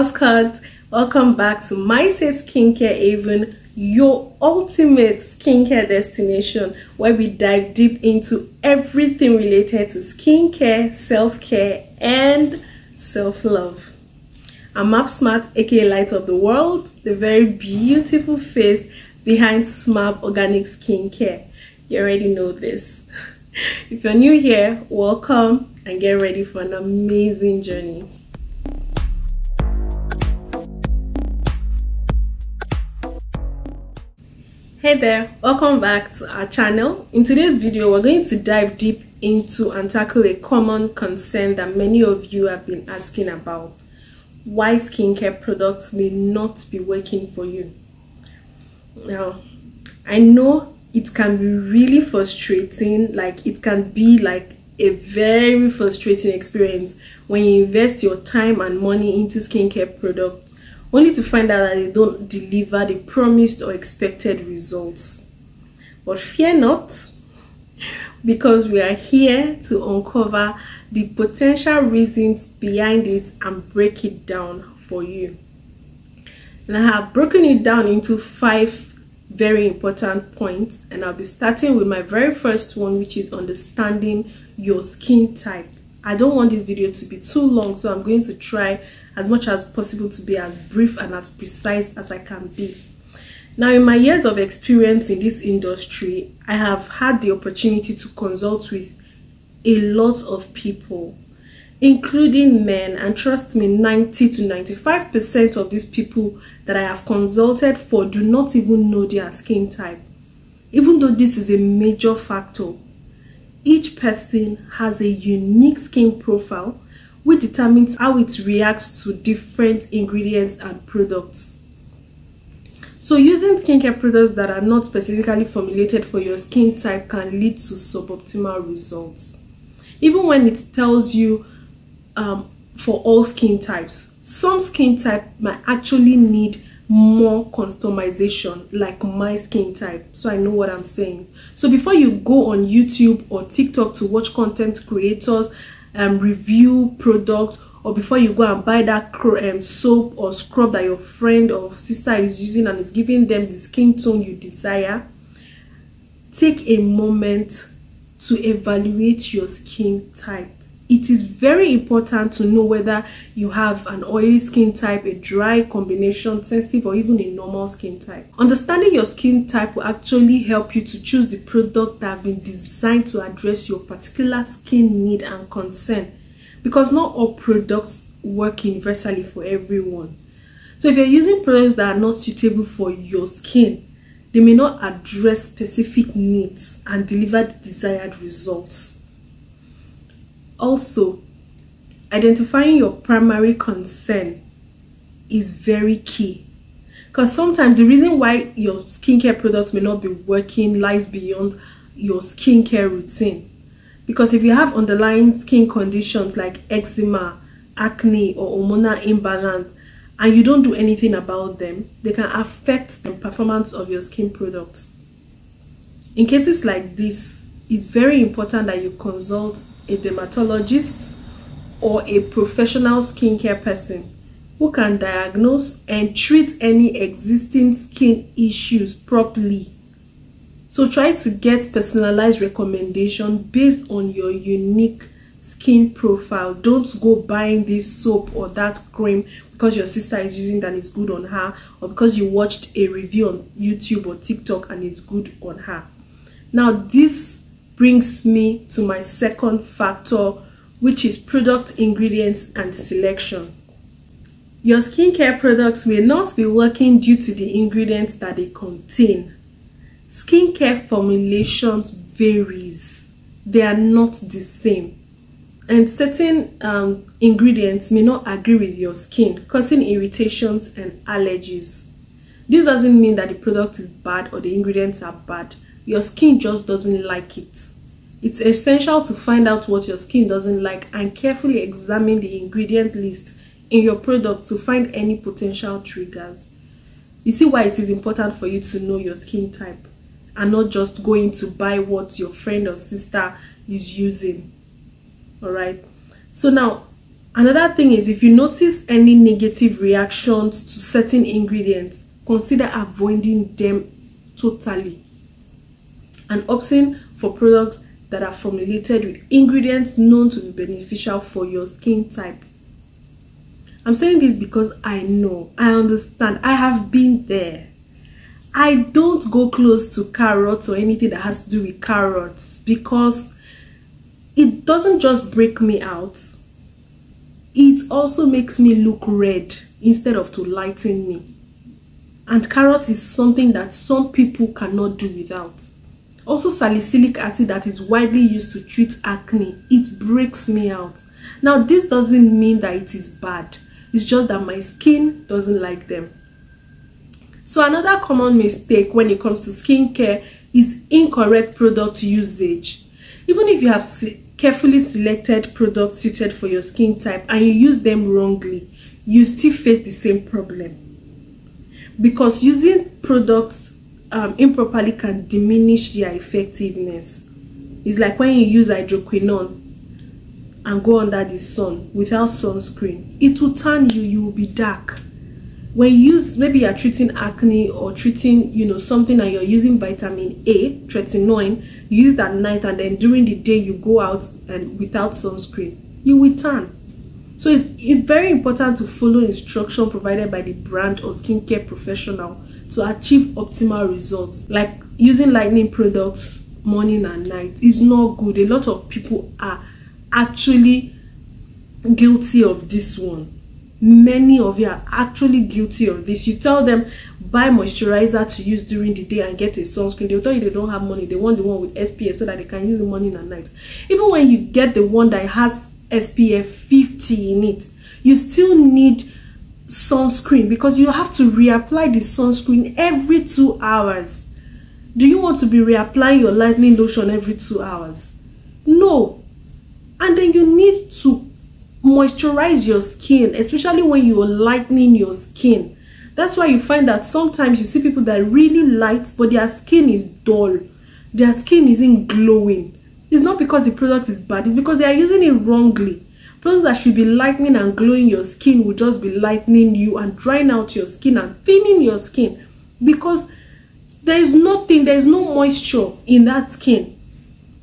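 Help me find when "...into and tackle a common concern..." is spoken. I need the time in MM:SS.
00:39.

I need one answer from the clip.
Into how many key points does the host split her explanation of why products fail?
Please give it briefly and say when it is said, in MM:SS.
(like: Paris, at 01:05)
5, at 01:18.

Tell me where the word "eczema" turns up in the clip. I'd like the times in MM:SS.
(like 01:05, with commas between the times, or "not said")
03:26.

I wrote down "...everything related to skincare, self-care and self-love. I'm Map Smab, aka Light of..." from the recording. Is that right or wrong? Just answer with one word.
right.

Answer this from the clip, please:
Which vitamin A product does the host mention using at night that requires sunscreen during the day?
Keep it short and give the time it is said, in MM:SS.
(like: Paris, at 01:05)
tretinoin, at 06:20.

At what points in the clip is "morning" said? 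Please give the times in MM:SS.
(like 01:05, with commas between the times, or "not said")
06:36, 06:52.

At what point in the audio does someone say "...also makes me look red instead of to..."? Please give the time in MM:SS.
05:27.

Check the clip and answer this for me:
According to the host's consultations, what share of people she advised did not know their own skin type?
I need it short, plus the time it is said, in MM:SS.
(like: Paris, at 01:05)
90 to 95%, at 01:43.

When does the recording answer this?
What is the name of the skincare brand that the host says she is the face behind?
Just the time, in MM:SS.
00:19.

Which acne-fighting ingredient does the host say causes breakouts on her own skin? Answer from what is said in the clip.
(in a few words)
salicylic acid.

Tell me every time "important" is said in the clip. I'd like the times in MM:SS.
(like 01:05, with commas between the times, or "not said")
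01:19, 02:41, 03:38, 04:47, 06:28.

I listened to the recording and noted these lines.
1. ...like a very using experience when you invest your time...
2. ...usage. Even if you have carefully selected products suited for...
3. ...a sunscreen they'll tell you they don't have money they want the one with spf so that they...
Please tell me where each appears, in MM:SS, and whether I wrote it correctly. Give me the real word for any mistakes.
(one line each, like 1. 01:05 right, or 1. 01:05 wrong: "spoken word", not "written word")
1. 00:54 wrong: "frustrating", not "using"
2. 05:52 right
3. 06:49 right.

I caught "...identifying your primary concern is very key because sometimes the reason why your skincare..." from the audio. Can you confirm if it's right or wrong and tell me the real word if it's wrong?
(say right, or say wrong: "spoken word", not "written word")
right.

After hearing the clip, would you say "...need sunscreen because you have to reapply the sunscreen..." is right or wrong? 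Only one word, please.
right.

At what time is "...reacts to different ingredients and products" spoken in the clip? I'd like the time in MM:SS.
01:58.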